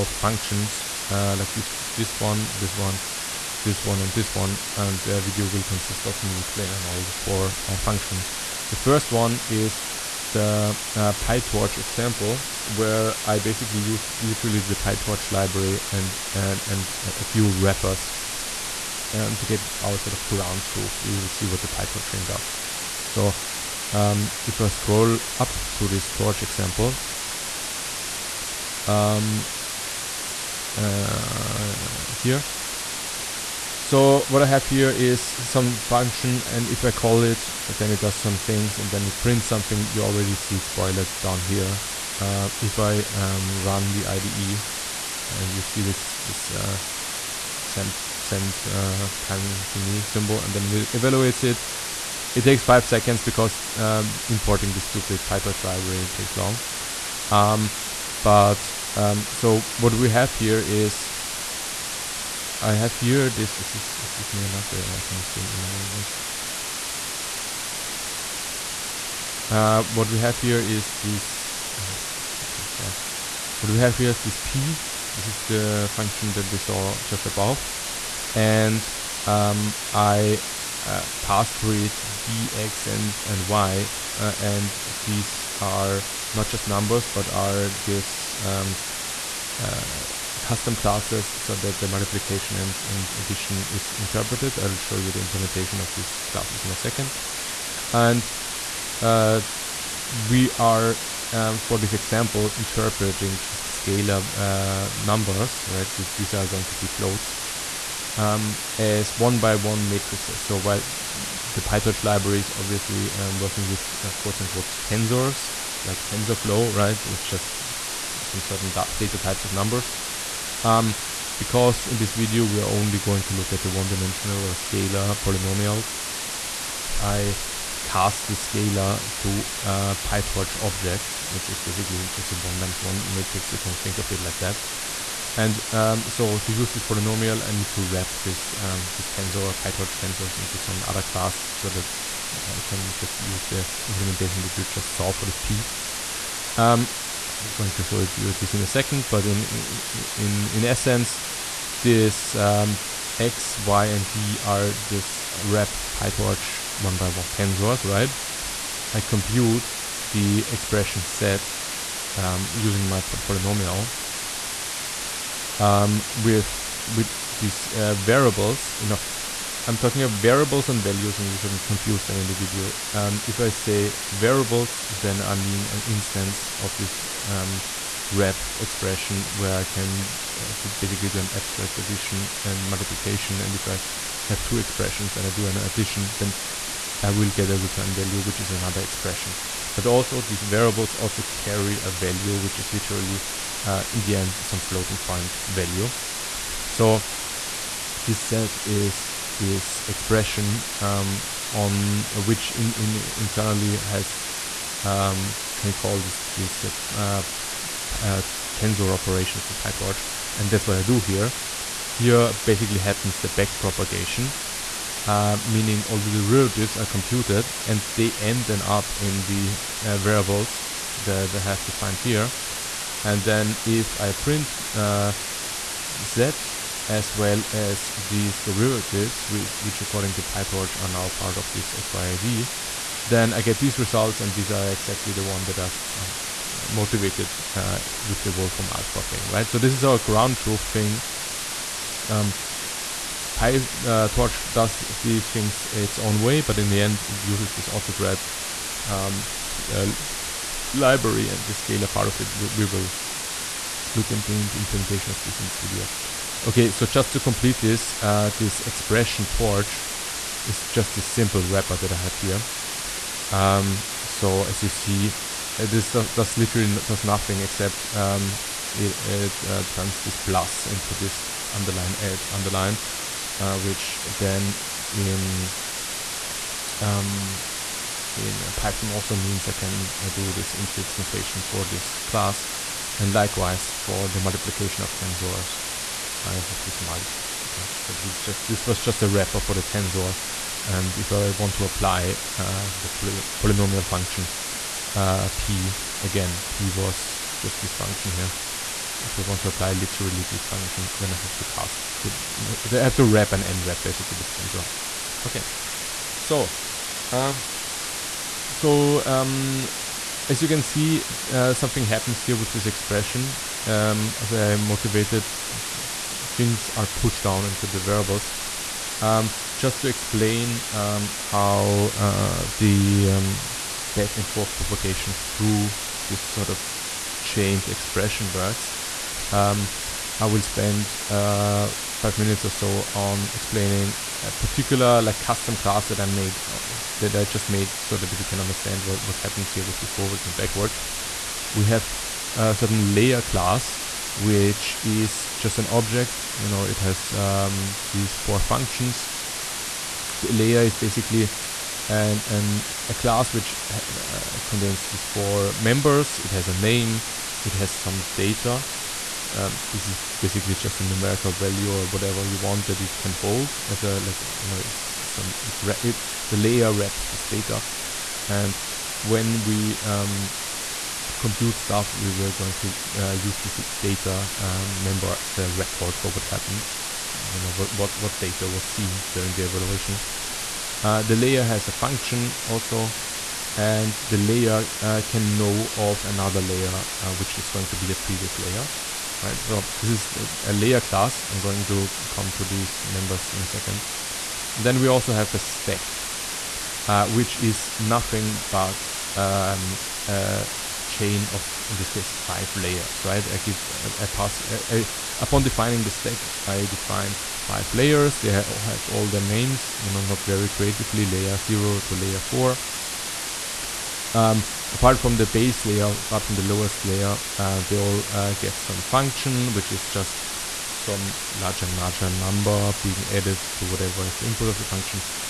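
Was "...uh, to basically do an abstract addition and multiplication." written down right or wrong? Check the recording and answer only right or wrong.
right.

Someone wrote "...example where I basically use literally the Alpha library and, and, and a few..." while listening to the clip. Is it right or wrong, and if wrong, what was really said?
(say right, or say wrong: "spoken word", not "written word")
wrong: "PyTorch", not "Alpha".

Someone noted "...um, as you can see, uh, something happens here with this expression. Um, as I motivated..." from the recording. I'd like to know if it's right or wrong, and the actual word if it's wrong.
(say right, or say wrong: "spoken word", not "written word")
right.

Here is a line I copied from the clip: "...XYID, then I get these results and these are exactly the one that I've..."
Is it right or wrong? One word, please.
right.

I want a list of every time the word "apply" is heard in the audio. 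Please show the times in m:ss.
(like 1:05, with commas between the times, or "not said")
4:51, 4:59.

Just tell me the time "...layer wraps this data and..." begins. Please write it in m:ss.
6:06.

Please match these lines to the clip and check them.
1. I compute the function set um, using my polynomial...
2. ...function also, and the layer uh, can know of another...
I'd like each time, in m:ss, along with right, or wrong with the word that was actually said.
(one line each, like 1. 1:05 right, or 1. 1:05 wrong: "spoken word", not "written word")
1. 2:38 wrong: "expression", not "function"
2. 6:21 right.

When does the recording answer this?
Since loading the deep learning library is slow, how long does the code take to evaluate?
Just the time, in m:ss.
0:52.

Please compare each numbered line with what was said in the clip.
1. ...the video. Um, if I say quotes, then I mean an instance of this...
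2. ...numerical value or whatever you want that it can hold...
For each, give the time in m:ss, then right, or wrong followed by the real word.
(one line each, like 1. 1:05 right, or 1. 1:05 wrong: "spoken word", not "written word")
1. 2:52 wrong: "variables", not "quotes"
2. 6:00 right.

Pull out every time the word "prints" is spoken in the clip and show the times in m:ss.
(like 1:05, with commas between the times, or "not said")
0:39, 3:44.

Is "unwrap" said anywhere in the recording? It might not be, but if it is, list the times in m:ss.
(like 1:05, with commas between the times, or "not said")
5:03.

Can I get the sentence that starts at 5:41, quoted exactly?
We have a certain layer class, which is just an object.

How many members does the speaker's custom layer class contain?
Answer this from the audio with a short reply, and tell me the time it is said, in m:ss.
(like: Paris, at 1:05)
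4, at 5:55.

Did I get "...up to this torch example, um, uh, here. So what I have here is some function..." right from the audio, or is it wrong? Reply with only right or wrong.
right.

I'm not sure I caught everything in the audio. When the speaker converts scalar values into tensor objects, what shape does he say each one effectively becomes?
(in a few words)
1 by 1 matrix.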